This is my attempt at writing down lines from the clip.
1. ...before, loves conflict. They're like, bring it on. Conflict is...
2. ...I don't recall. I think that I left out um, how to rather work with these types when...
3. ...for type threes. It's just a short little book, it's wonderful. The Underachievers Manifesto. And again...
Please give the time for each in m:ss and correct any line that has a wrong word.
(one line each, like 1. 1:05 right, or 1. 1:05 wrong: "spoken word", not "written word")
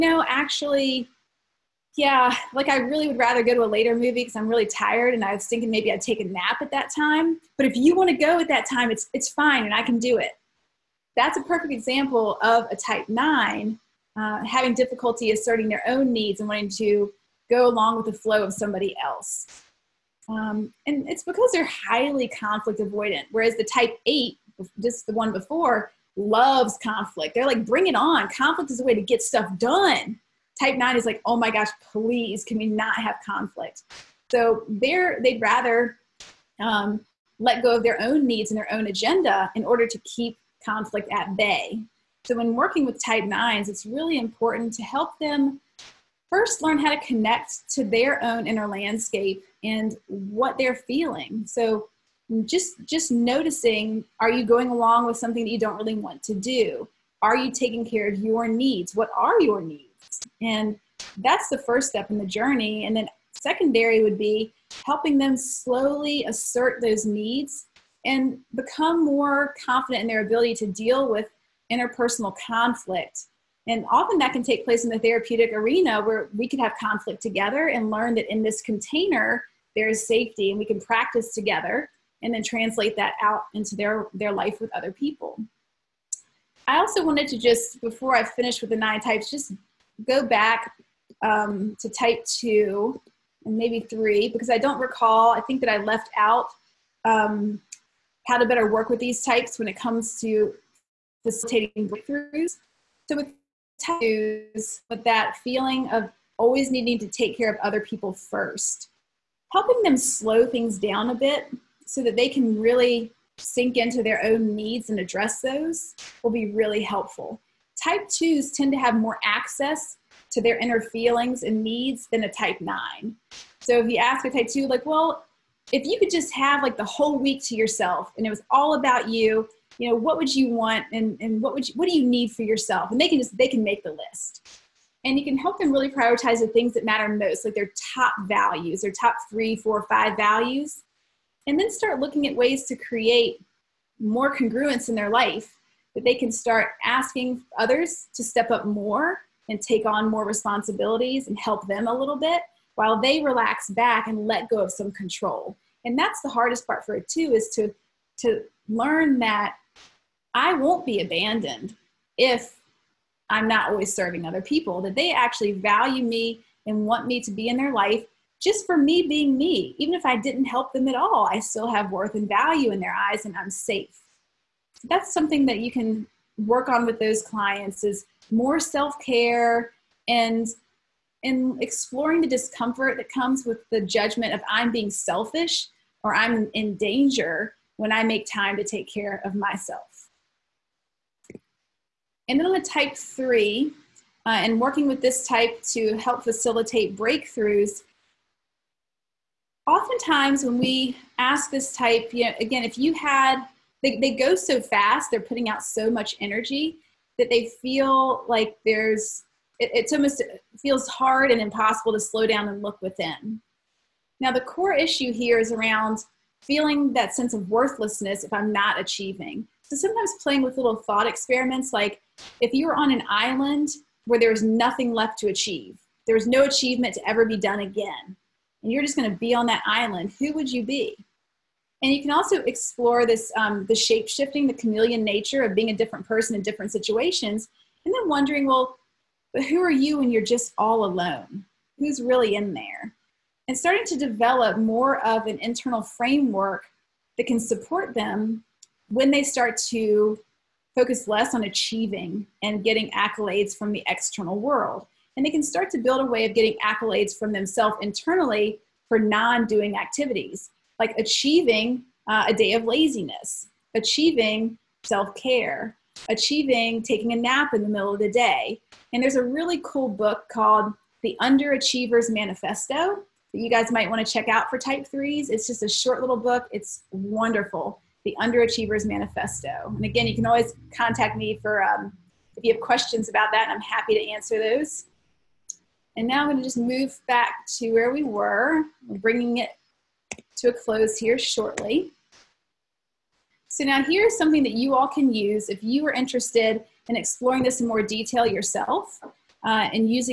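1. 0:25 right
2. 1:34 wrong: "better", not "rather"
3. 4:34 right.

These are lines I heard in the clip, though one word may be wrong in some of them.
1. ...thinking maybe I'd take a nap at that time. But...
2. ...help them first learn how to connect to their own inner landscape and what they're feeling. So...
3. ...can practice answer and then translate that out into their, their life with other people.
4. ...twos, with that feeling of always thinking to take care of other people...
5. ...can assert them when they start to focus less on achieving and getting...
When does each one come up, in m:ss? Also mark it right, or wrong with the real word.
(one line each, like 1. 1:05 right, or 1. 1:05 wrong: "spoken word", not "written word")
1. 0:05 right
2. 0:44 right
3. 1:20 wrong: "together", not "answer"
4. 1:43 wrong: "needing", not "thinking"
5. 4:07 wrong: "support", not "assert".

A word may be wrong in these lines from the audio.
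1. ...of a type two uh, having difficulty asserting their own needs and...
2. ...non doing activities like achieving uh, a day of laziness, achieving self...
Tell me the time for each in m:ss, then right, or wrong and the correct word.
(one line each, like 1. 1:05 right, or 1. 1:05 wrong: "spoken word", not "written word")
1. 0:12 wrong: "nine", not "two"
2. 4:18 right.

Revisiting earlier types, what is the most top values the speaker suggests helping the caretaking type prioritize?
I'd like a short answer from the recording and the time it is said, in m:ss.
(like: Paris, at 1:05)
5, at 2:19.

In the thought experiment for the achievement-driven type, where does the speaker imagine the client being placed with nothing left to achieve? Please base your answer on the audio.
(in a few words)
an island.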